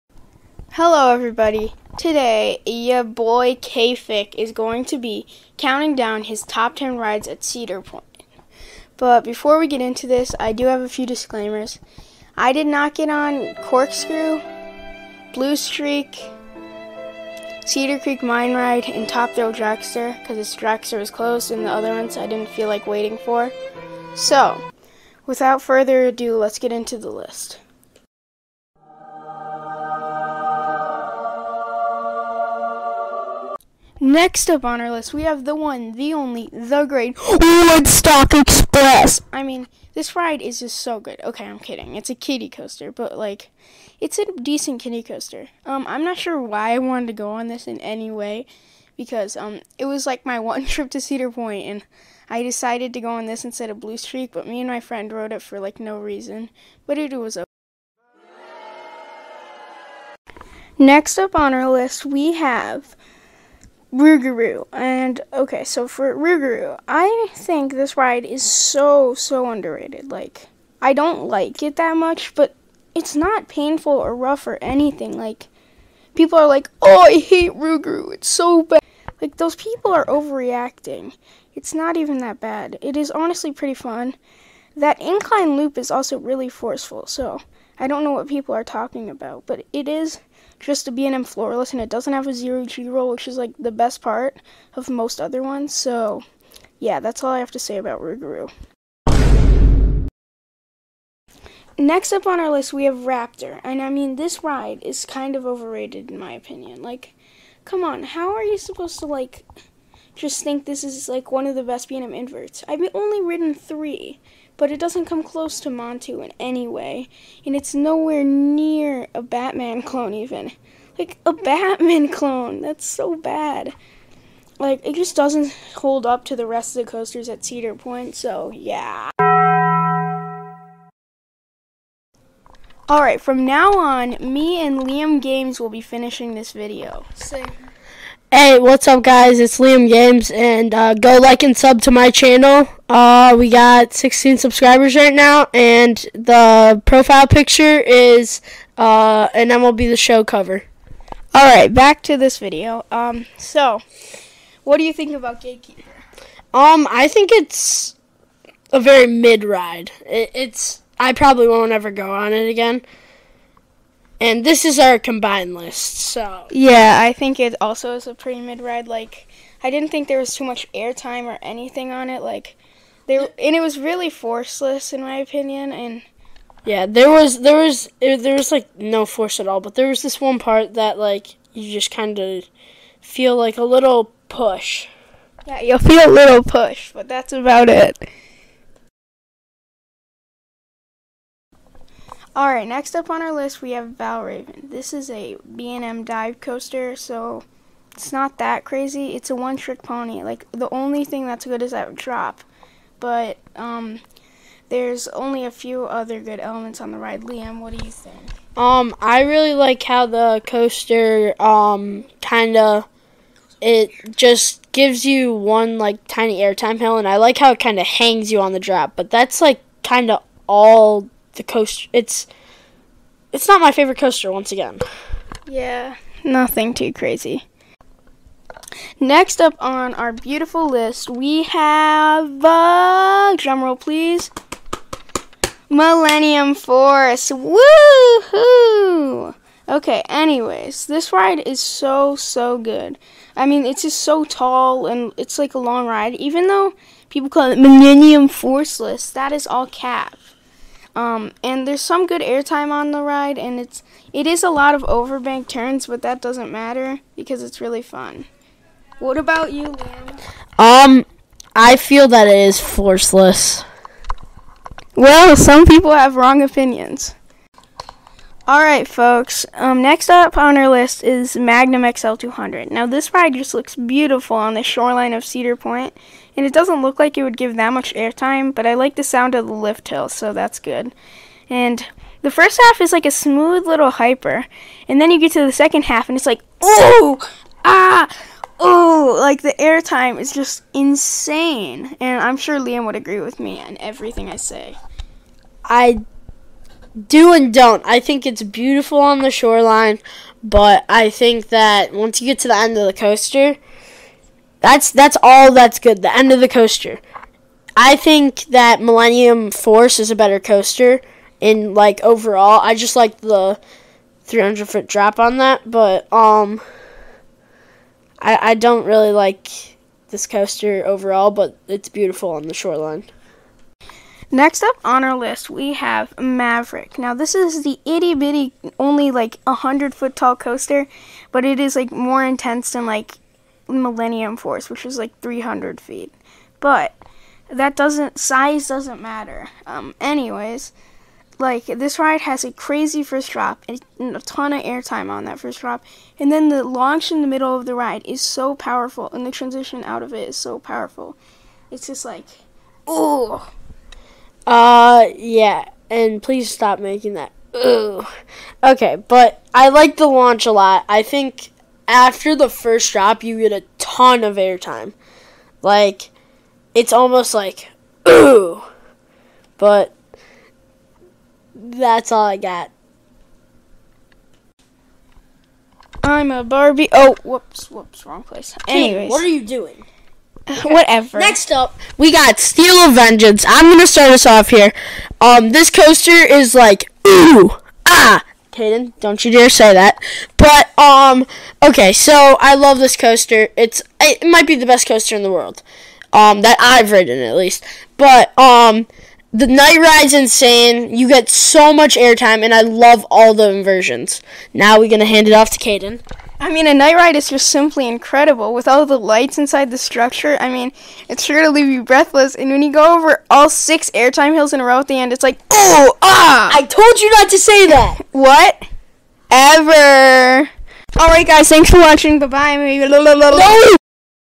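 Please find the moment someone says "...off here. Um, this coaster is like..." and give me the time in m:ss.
6:24.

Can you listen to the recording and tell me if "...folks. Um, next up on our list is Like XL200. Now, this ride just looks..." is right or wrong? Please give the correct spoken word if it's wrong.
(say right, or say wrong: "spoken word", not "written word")
wrong: "Magnum", not "Like".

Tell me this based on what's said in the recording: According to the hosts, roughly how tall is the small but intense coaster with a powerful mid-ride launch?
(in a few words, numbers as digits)
100 feet.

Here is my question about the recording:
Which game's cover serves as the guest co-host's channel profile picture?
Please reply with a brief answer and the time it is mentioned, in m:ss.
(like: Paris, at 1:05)
MLB The Show, at 2:29.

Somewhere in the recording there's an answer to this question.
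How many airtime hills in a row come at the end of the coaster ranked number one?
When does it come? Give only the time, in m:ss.
6:53.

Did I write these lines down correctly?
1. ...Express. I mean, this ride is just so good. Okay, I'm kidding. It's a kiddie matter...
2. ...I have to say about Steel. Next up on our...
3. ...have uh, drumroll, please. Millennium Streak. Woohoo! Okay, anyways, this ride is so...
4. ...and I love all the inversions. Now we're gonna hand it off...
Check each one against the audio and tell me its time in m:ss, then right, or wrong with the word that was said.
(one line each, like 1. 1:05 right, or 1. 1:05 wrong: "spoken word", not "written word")
1. 0:38 wrong: "coaster", not "matter"
2. 1:37 wrong: "Rougarou", not "Steel"
3. 3:51 wrong: "Force", not "Streak"
4. 6:42 right.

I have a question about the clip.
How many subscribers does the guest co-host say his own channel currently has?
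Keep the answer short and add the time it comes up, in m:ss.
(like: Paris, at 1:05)
16, at 2:23.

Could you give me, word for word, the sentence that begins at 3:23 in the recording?
But, um, there's only a few other good elements on the ride.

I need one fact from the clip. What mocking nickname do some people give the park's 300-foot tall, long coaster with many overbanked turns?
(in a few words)
Millennium Forceless.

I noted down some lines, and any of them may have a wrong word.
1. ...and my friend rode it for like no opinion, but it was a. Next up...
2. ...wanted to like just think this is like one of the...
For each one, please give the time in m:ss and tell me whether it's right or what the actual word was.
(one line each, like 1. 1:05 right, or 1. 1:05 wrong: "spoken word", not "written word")
1. 0:54 wrong: "reason", not "opinion"
2. 1:48 wrong: "supposed", not "wanted".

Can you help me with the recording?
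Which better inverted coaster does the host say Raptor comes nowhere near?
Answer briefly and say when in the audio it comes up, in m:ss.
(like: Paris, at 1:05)
Montu, at 1:55.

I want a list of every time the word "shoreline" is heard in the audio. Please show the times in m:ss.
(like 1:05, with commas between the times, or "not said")
4:34, 4:59, 5:22.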